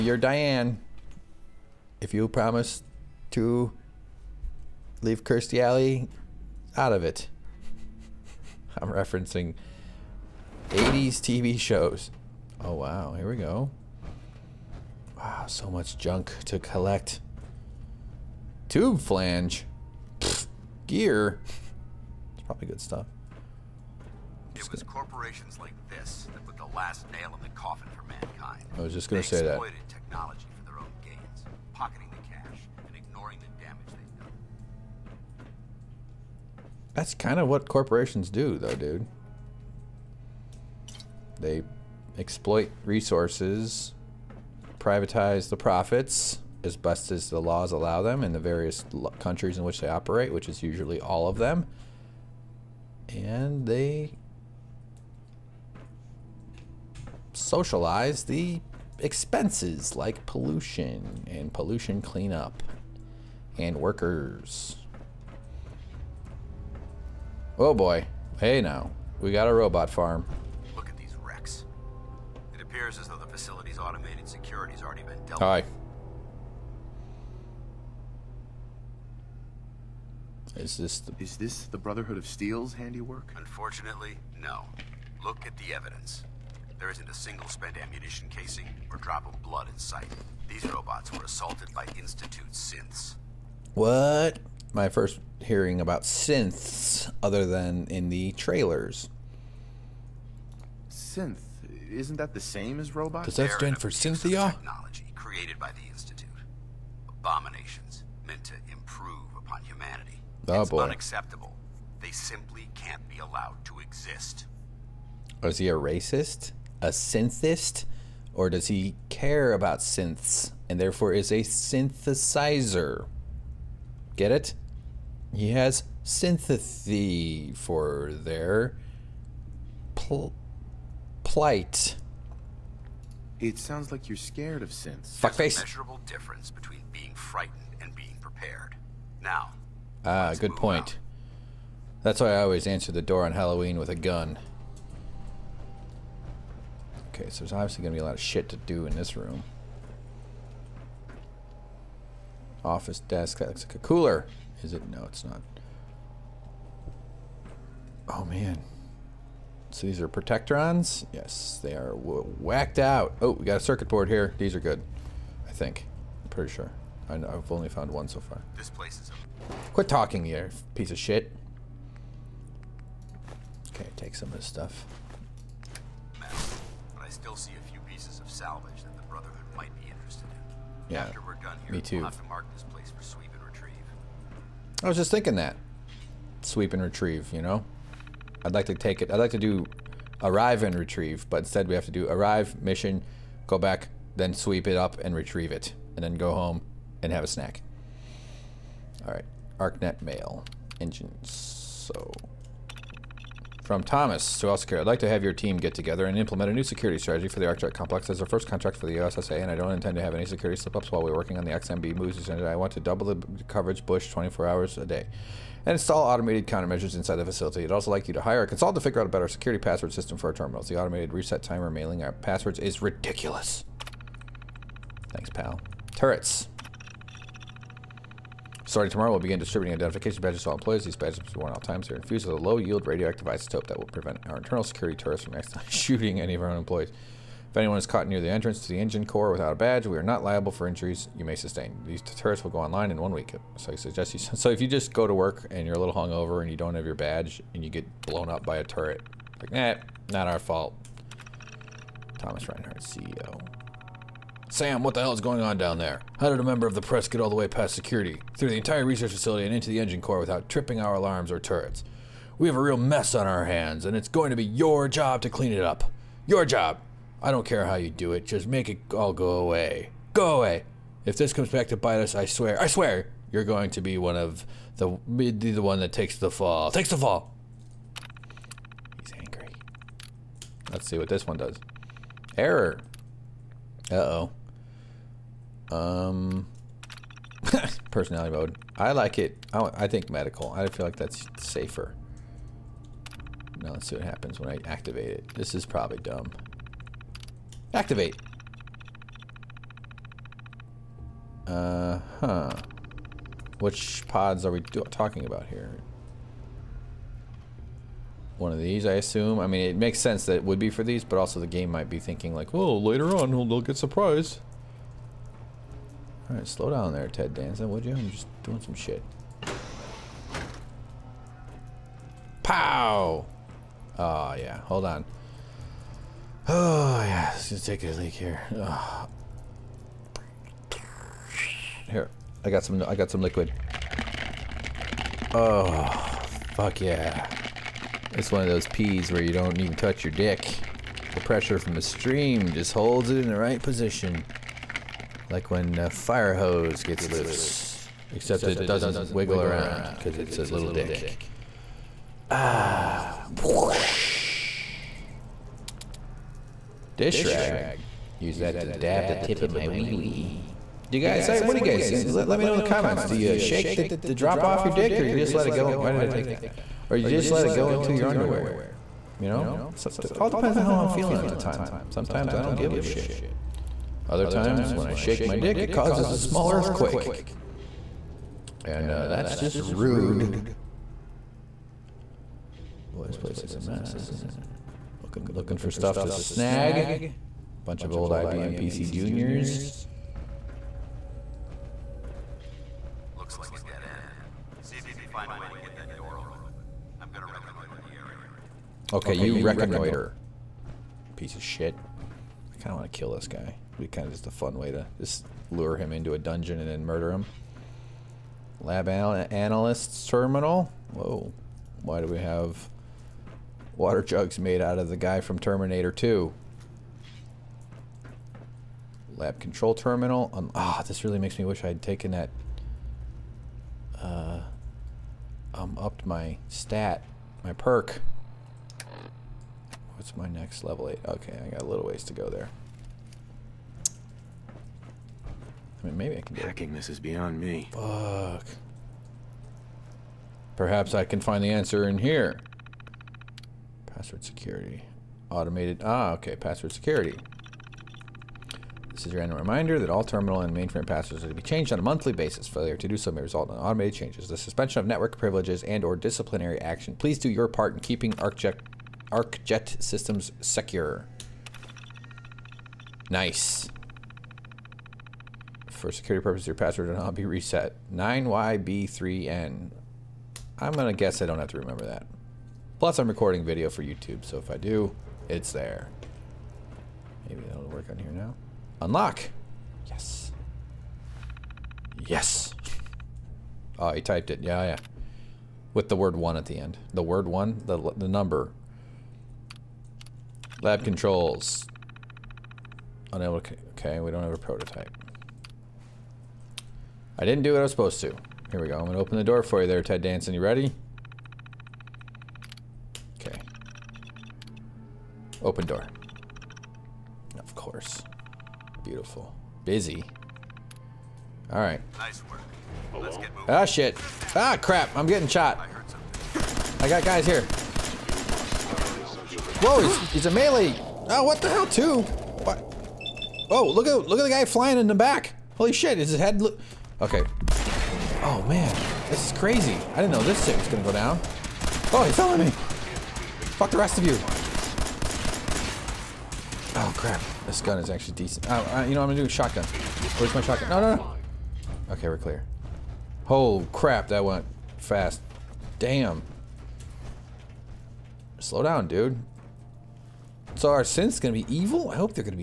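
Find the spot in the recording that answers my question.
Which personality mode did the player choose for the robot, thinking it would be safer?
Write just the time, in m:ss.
4:50.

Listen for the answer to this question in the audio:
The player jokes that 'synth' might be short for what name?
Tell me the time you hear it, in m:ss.
1:43.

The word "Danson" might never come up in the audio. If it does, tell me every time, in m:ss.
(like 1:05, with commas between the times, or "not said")
5:17, 8:20.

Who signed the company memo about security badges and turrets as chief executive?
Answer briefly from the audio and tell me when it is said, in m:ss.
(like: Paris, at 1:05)
Thomas Reinhardt, at 4:12.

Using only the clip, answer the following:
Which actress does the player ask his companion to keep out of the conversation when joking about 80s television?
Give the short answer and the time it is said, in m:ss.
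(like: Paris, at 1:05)
Kirstie Alley, at 0:05.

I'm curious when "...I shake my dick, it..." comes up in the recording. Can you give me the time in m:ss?
6:14.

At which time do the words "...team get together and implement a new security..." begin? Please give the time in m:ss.
3:25.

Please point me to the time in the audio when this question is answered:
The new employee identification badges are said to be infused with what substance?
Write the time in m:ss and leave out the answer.
3:52.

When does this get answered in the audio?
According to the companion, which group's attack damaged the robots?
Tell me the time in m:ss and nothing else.
1:31.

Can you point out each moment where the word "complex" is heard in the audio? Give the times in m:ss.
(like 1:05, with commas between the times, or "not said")
3:27.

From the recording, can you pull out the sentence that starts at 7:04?
Uh, um, upped my stat, my perk.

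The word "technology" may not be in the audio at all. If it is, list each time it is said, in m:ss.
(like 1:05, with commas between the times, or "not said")
0:29, 1:44.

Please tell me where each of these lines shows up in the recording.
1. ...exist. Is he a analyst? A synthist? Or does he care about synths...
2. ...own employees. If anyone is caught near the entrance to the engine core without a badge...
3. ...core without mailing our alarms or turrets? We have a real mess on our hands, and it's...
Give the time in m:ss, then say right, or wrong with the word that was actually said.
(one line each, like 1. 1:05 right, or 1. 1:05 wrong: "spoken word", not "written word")
1. 1:53 wrong: "racist", not "analyst"
2. 3:56 right
3. 4:20 wrong: "tripping", not "mailing".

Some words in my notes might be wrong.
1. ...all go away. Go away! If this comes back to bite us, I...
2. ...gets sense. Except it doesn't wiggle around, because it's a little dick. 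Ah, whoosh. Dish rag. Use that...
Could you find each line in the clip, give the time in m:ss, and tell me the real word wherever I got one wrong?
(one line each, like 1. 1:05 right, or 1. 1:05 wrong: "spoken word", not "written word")
1. 4:28 right
2. 5:46 wrong: "loose", not "sense".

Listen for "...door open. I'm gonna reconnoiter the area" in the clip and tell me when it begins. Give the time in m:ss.
6:35.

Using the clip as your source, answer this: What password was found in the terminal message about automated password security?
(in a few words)
9YB3N.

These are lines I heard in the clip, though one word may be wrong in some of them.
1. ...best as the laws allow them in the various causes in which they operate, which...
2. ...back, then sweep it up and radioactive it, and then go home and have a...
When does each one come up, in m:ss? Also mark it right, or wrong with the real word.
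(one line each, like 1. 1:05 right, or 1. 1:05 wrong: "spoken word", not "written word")
1. 0:46 wrong: "countries", not "causes"
2. 3:13 wrong: "retrieve", not "radioactive".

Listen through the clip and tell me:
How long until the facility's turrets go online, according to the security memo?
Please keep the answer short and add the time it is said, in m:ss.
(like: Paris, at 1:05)
One week, at 4:03.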